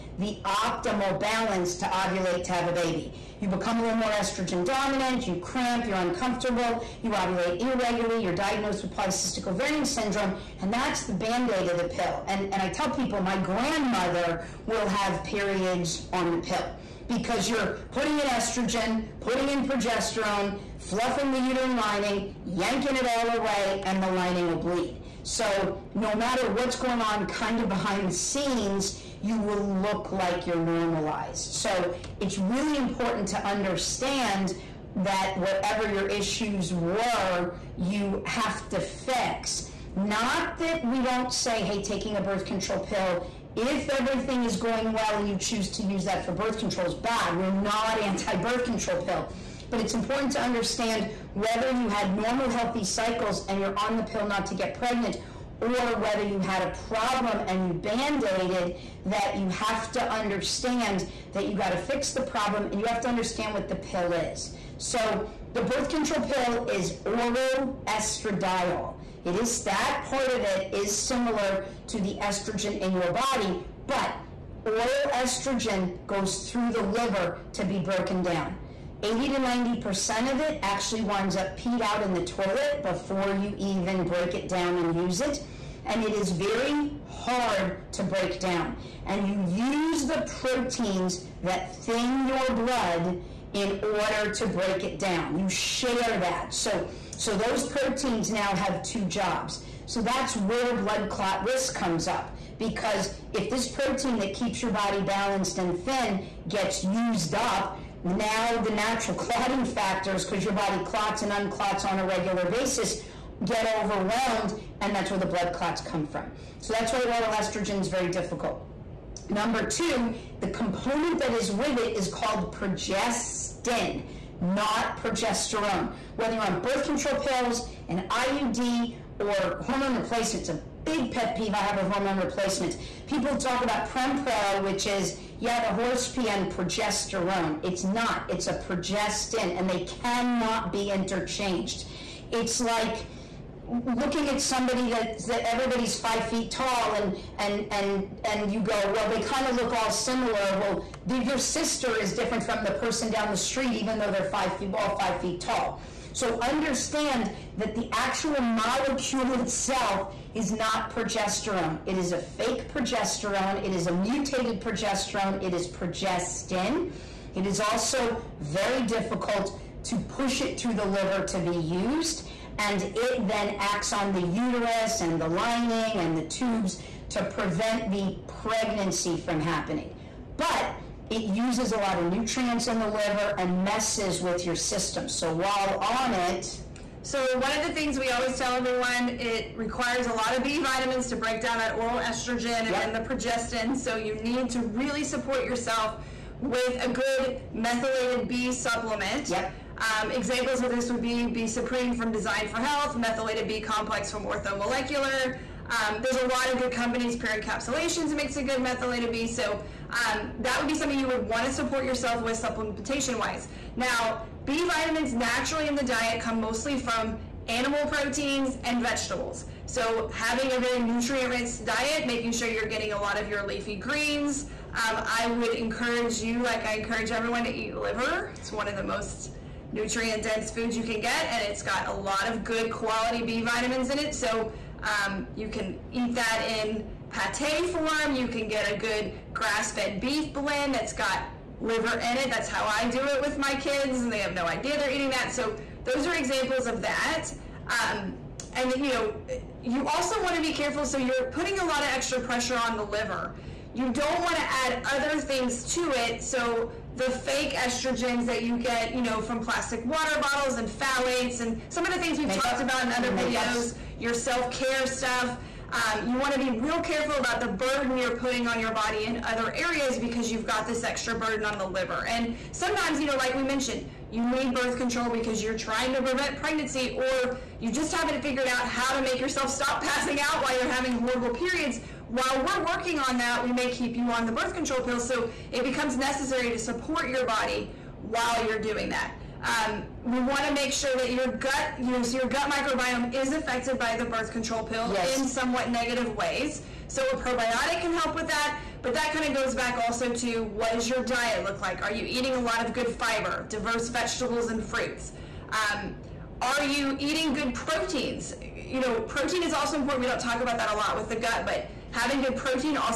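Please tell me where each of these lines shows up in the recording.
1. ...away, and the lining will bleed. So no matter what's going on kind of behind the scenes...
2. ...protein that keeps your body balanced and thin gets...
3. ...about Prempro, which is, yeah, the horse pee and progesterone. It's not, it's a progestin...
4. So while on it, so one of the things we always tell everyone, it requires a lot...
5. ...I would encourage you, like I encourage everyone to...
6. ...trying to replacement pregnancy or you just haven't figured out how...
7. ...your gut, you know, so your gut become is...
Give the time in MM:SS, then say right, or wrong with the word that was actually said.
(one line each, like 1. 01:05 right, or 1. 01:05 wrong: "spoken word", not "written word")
1. 00:23 right
2. 01:43 right
3. 02:13 right
4. 03:05 right
5. 03:45 right
6. 04:35 wrong: "prevent", not "replacement"
7. 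04:51 wrong: "microbiome", not "become".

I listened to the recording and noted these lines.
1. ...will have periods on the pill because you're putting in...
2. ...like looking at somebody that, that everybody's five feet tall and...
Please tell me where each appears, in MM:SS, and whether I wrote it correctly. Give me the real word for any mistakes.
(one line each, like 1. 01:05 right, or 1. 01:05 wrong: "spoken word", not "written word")
1. 00:14 right
2. 02:22 right.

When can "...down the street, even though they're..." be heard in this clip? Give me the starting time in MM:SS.
02:33.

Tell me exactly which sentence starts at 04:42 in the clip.
While we're working on that, we may keep you on the birth control pill.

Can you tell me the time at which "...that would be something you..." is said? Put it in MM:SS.
03:30.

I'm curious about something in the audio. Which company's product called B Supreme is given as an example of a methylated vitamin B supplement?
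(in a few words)
Design for Health.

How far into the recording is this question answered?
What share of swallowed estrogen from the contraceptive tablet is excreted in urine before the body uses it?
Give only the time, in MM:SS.
01:19.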